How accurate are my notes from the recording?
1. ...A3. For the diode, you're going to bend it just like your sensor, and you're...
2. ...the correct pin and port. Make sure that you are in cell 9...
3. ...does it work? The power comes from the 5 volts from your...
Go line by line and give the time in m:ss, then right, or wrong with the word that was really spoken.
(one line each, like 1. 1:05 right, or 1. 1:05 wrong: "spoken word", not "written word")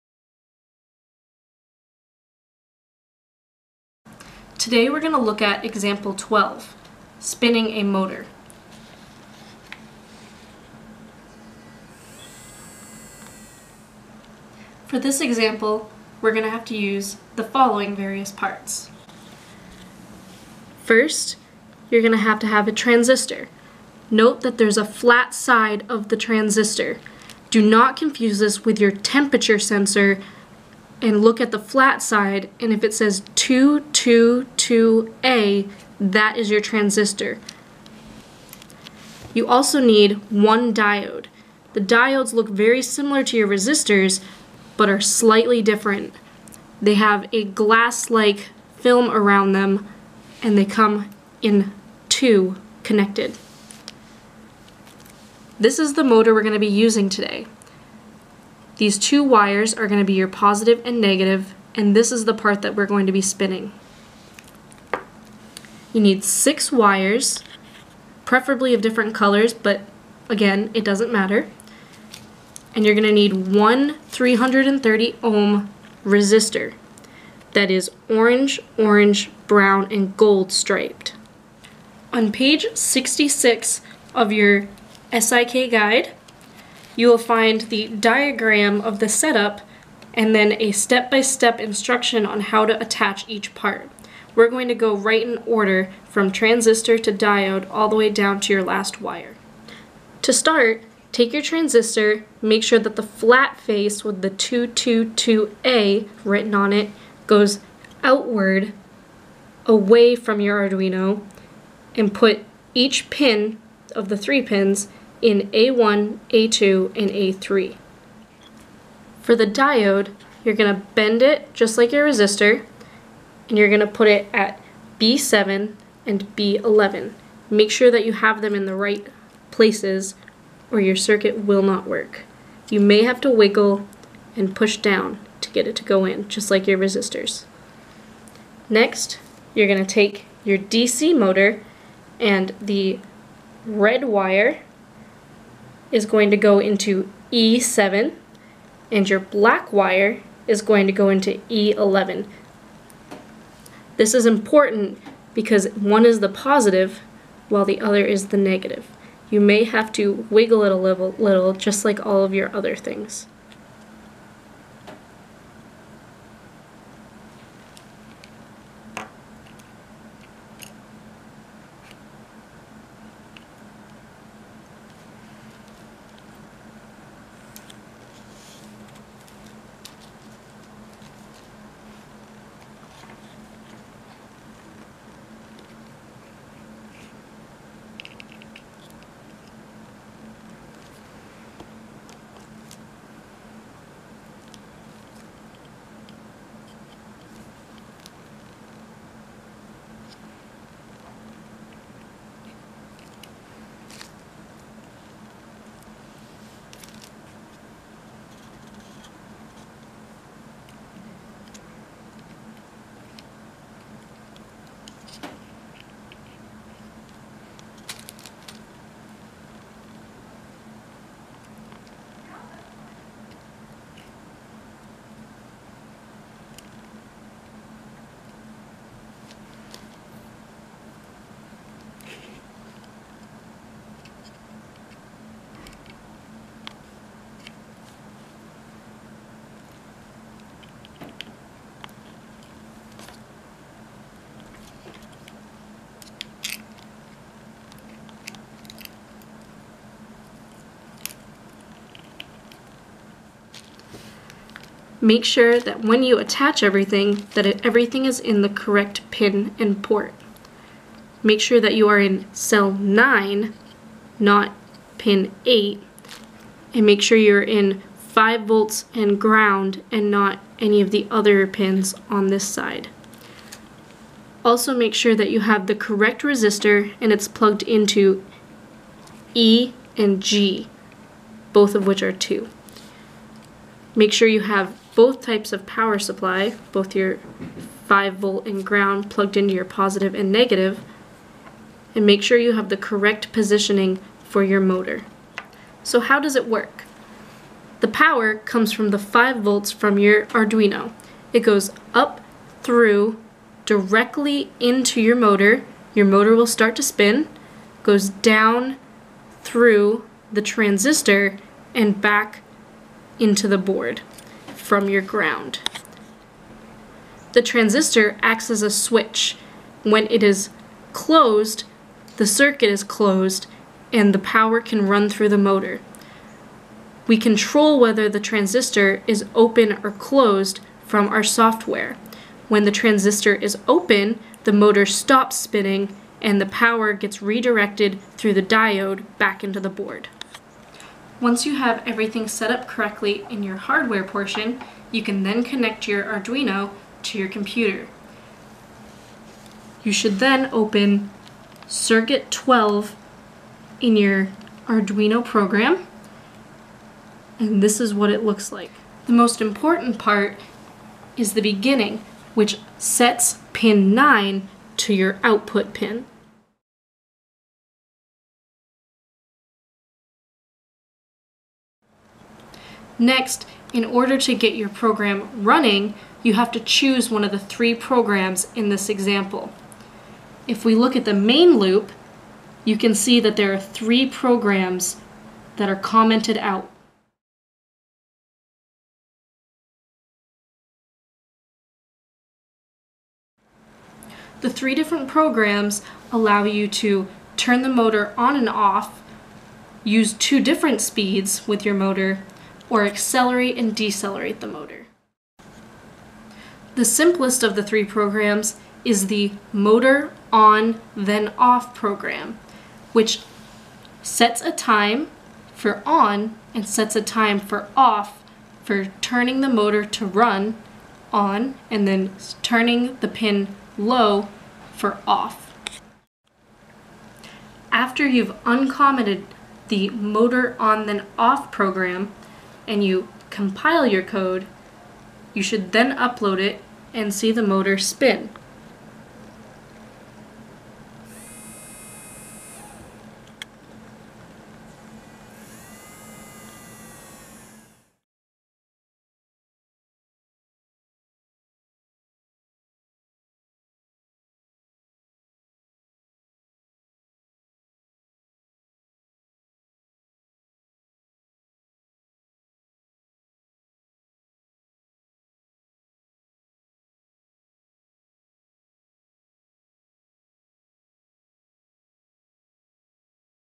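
1. 1:57 wrong: "resistor", not "sensor"
2. 4:18 right
3. 4:56 right.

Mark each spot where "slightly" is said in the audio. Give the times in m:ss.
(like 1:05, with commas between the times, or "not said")
0:45.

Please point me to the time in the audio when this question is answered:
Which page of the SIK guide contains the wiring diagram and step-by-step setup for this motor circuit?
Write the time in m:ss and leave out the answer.
1:22.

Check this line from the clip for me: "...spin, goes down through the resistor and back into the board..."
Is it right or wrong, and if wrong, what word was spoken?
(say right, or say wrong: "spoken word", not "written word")
wrong: "transistor", not "resistor".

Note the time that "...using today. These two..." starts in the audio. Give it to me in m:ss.
0:56.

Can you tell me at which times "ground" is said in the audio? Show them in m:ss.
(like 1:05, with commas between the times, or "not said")
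4:29, 4:48, 5:15.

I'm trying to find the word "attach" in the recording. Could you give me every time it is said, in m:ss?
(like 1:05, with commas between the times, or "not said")
1:32, 4:16.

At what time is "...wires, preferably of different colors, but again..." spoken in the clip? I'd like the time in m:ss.
1:06.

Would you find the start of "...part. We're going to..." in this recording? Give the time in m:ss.
1:33.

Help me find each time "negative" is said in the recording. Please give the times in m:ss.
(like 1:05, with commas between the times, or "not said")
1:00, 2:38, 4:50.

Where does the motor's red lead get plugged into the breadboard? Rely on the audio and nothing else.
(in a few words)
E7.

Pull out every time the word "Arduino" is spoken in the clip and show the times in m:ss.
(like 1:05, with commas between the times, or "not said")
1:50, 5:00, 5:46, 5:54.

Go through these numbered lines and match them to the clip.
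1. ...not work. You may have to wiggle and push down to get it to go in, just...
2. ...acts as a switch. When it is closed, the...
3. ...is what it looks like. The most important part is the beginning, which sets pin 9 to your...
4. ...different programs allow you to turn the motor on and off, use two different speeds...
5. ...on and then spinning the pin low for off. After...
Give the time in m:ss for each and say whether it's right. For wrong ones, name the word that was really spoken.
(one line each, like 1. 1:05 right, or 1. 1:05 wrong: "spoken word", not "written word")
1. 2:11 right
2. 5:18 right
3. 5:57 right
4. 6:34 right
5. 7:01 wrong: "turning", not "spinning".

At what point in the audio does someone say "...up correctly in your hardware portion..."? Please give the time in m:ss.
5:42.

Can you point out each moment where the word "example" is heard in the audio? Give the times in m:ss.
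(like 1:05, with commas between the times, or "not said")
0:05, 0:15, 6:18.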